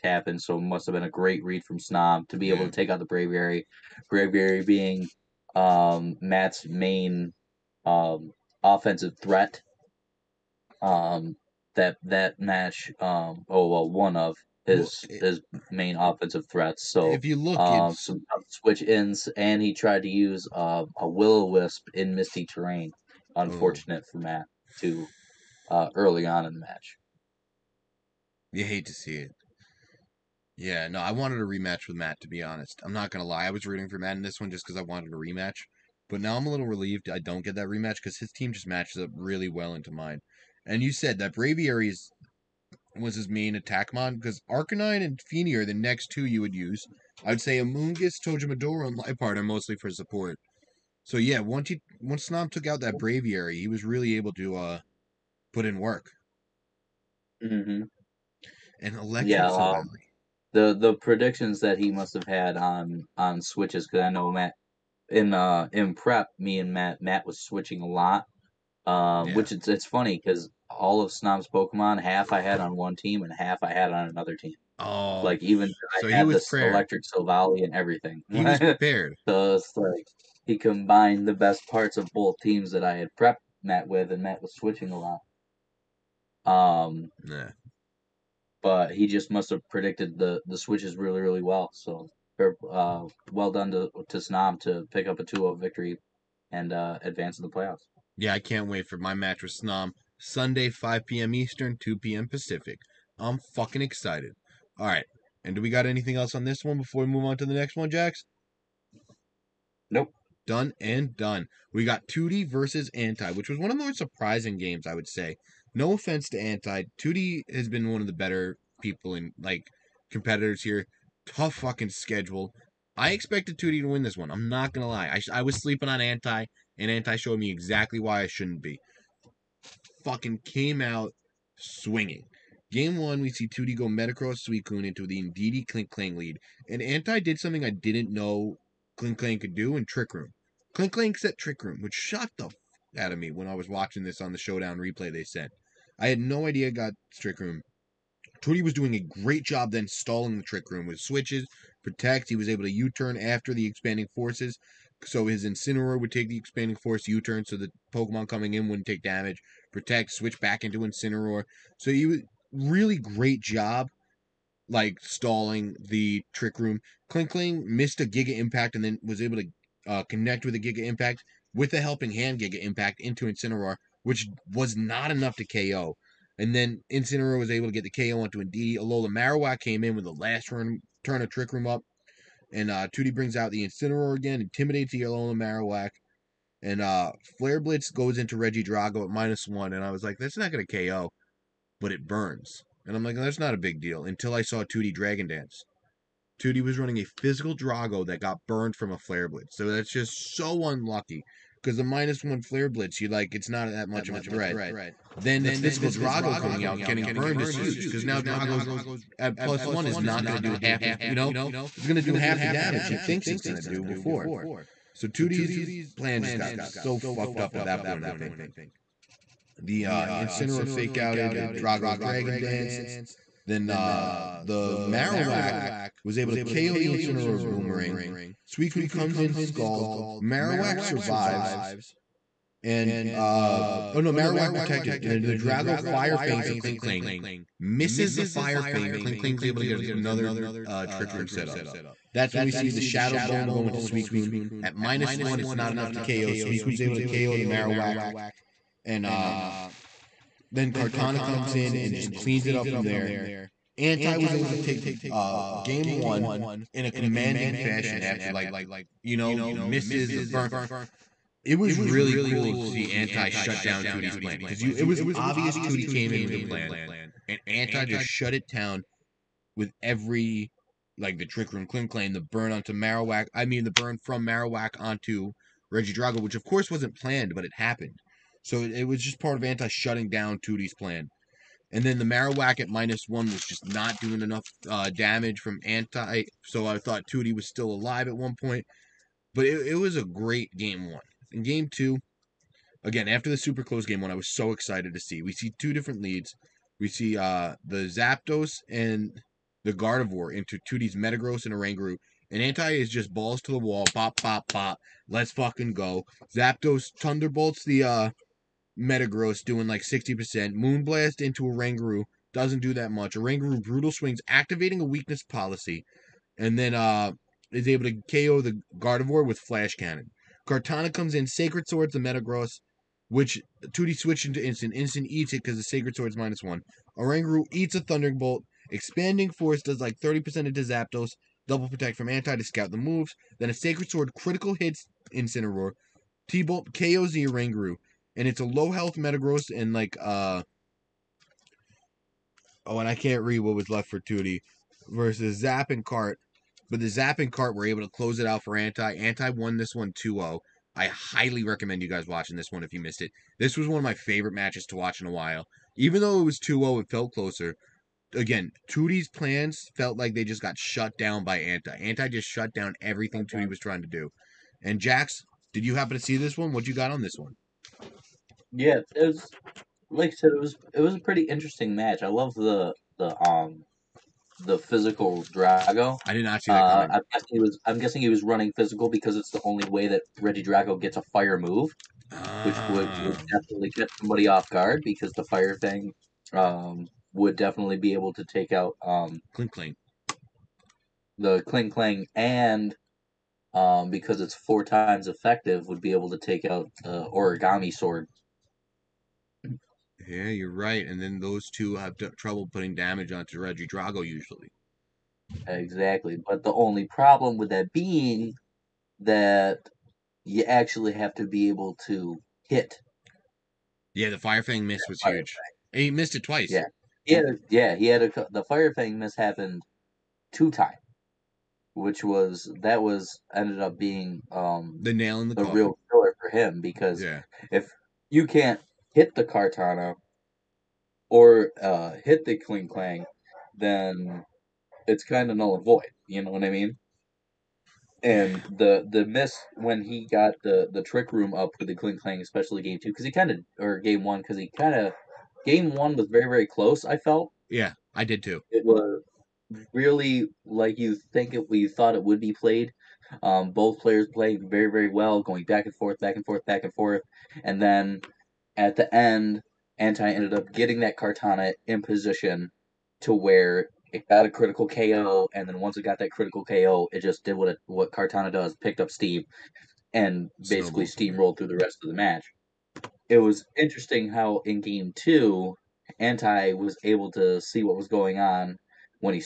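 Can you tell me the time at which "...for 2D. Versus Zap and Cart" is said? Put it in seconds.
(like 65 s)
343 s.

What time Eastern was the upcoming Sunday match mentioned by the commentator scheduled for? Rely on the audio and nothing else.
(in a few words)
5 p.m.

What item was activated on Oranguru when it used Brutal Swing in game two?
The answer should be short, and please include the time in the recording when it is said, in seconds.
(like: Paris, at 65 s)
Weakness Policy, at 314 s.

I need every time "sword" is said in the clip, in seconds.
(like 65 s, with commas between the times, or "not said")
321 s, 325 s, 333 s, 397 s.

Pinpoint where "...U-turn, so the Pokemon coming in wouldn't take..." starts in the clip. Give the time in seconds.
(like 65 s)
157 s.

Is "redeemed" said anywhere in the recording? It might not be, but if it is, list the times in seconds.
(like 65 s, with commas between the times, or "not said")
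not said.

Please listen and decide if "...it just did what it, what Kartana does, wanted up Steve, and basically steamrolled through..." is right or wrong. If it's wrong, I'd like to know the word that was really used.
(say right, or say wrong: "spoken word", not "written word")
wrong: "picked", not "wanted".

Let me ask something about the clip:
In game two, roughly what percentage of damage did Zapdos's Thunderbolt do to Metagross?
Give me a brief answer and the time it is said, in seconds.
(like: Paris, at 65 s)
60%, at 309 s.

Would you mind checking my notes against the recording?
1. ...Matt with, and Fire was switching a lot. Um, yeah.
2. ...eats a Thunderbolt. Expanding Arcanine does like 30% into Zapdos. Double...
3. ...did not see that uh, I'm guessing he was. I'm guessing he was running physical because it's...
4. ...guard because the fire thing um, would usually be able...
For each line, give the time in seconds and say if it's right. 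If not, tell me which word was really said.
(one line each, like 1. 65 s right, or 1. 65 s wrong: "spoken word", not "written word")
1. 83 s wrong: "Matt", not "Fire"
2. 327 s wrong: "Force", not "Arcanine"
3. 376 s right
4. 384 s wrong: "definitely", not "usually".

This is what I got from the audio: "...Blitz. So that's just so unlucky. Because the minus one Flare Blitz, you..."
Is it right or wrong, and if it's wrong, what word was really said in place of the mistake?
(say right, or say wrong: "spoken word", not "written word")
right.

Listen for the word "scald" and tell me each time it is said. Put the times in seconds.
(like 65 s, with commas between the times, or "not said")
229 s.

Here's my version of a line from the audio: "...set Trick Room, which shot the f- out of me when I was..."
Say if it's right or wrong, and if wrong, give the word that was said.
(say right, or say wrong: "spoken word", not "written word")
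right.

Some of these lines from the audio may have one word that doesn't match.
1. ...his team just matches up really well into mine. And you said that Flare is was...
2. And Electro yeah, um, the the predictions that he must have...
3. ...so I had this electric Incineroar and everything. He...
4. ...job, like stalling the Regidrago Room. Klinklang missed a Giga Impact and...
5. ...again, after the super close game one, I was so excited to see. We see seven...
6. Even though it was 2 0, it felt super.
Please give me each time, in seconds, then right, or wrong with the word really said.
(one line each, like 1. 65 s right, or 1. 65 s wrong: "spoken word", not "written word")
1. 38 s wrong: "Braviary", not "Flare"
2. 58 s right
3. 75 s wrong: "Silvally", not "Incineroar"
4. 163 s wrong: "Trick", not "Regidrago"
5. 292 s wrong: "two", not "seven"
6. 355 s wrong: "closer", not "super".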